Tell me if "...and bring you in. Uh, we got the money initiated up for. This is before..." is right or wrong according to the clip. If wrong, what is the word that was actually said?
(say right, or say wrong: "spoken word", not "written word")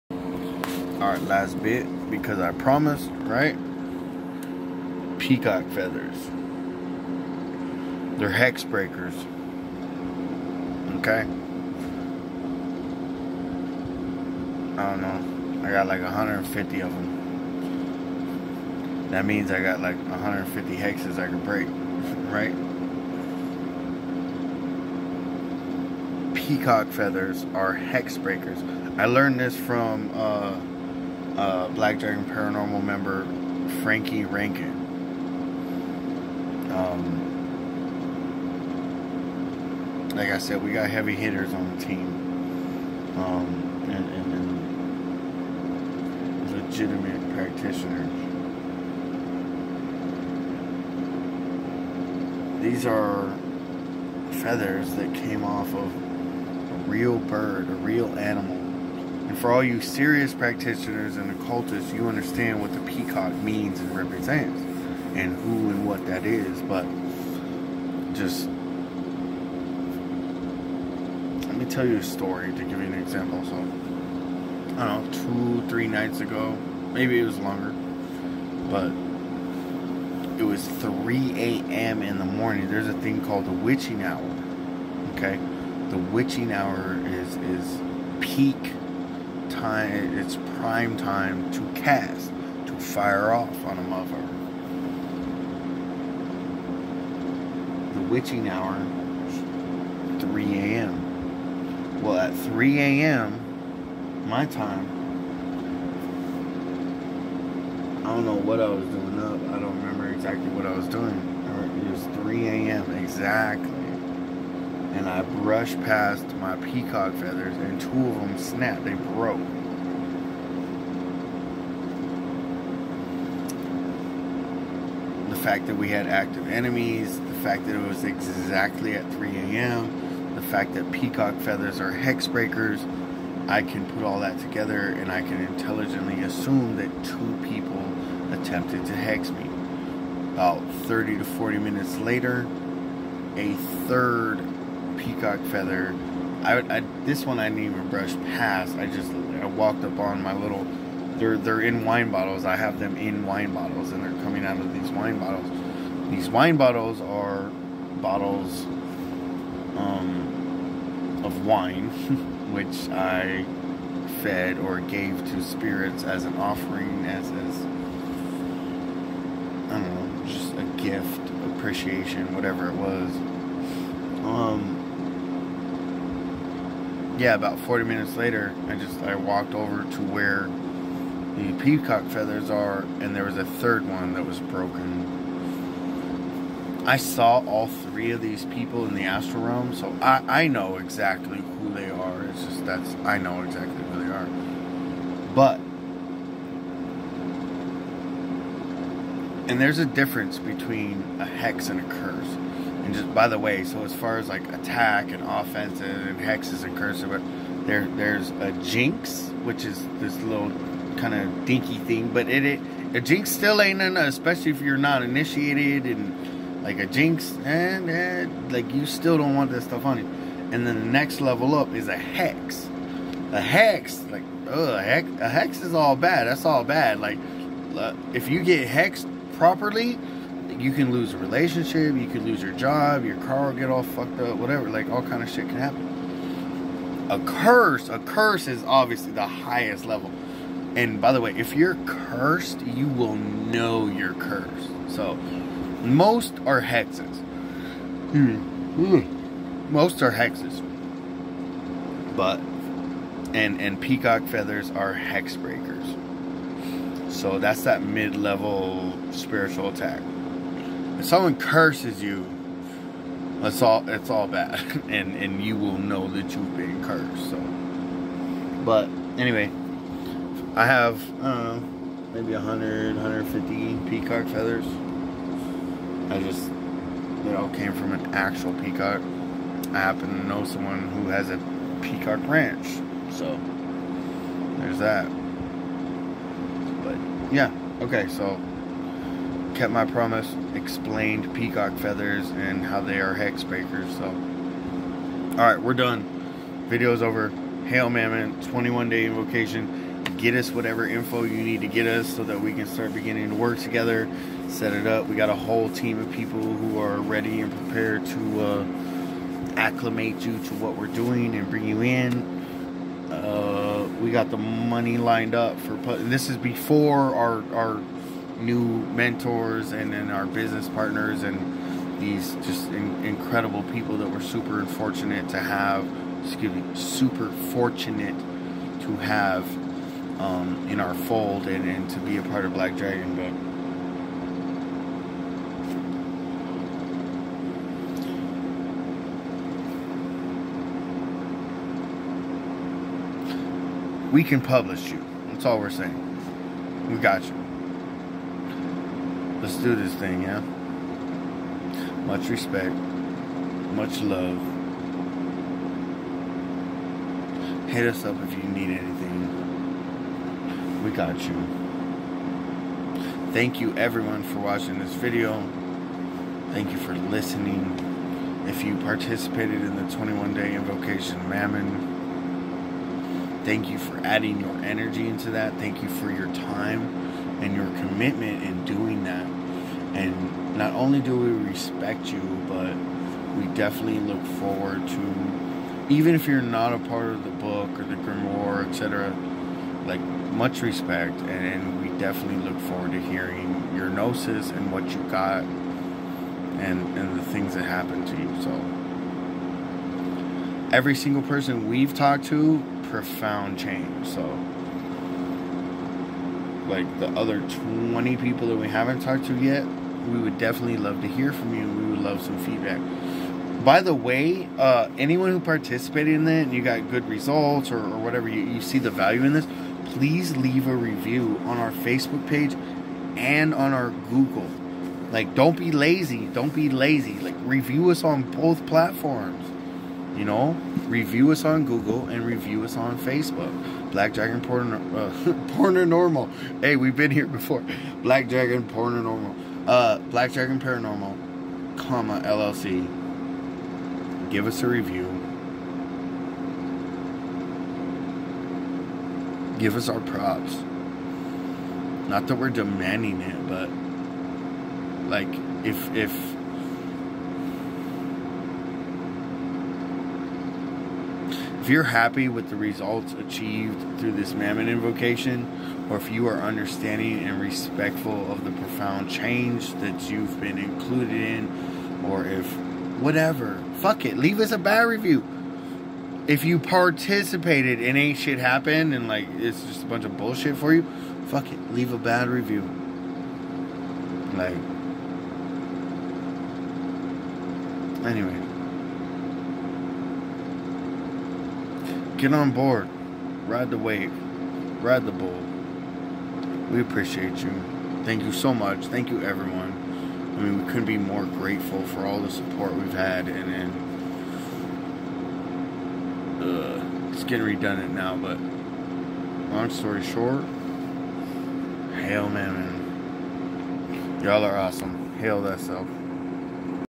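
wrong: "lined", not "initiated".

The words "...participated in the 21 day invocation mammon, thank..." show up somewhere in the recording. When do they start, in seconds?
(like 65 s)
368 s.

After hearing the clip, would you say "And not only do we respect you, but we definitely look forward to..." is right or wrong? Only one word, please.
right.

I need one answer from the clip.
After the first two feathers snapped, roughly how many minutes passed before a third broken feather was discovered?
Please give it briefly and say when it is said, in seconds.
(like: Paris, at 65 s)
30 to 40, at 140 s.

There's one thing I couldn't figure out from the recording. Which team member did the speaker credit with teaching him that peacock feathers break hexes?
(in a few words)
Frankie Rankin.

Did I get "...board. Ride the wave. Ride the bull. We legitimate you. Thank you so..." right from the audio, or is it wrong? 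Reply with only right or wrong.
wrong.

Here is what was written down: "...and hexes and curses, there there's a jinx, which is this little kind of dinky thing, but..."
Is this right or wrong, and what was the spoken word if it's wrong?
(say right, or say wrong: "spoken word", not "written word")
right.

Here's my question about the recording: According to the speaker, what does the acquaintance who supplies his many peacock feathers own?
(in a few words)
a peacock ranch.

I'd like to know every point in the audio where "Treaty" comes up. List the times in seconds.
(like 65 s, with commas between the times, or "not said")
not said.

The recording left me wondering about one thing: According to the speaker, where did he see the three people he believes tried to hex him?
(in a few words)
the astral realm.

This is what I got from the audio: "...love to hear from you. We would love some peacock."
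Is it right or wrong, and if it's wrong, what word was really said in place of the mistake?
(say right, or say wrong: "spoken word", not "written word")
wrong: "feedback", not "peacock".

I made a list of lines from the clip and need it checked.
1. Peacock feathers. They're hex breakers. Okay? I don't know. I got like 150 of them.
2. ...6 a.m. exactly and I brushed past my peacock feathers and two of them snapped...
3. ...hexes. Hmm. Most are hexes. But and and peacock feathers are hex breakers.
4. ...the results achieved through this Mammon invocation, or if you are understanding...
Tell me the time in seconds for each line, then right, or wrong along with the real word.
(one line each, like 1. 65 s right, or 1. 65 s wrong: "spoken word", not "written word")
1. 5 s right
2. 112 s wrong: "3", not "6"
3. 246 s right
4. 462 s right.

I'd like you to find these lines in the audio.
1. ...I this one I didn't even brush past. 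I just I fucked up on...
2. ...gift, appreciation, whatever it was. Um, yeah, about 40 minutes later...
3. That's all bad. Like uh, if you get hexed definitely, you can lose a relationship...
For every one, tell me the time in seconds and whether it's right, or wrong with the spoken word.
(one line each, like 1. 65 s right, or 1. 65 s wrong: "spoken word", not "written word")
1. 146 s wrong: "walked", not "fucked"
2. 170 s right
3. 226 s wrong: "properly", not "definitely".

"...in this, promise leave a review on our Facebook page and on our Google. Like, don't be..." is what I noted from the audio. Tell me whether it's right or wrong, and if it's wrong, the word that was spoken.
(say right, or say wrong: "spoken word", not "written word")
wrong: "please", not "promise".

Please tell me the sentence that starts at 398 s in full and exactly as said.
So, every single person we've talked to, profound change.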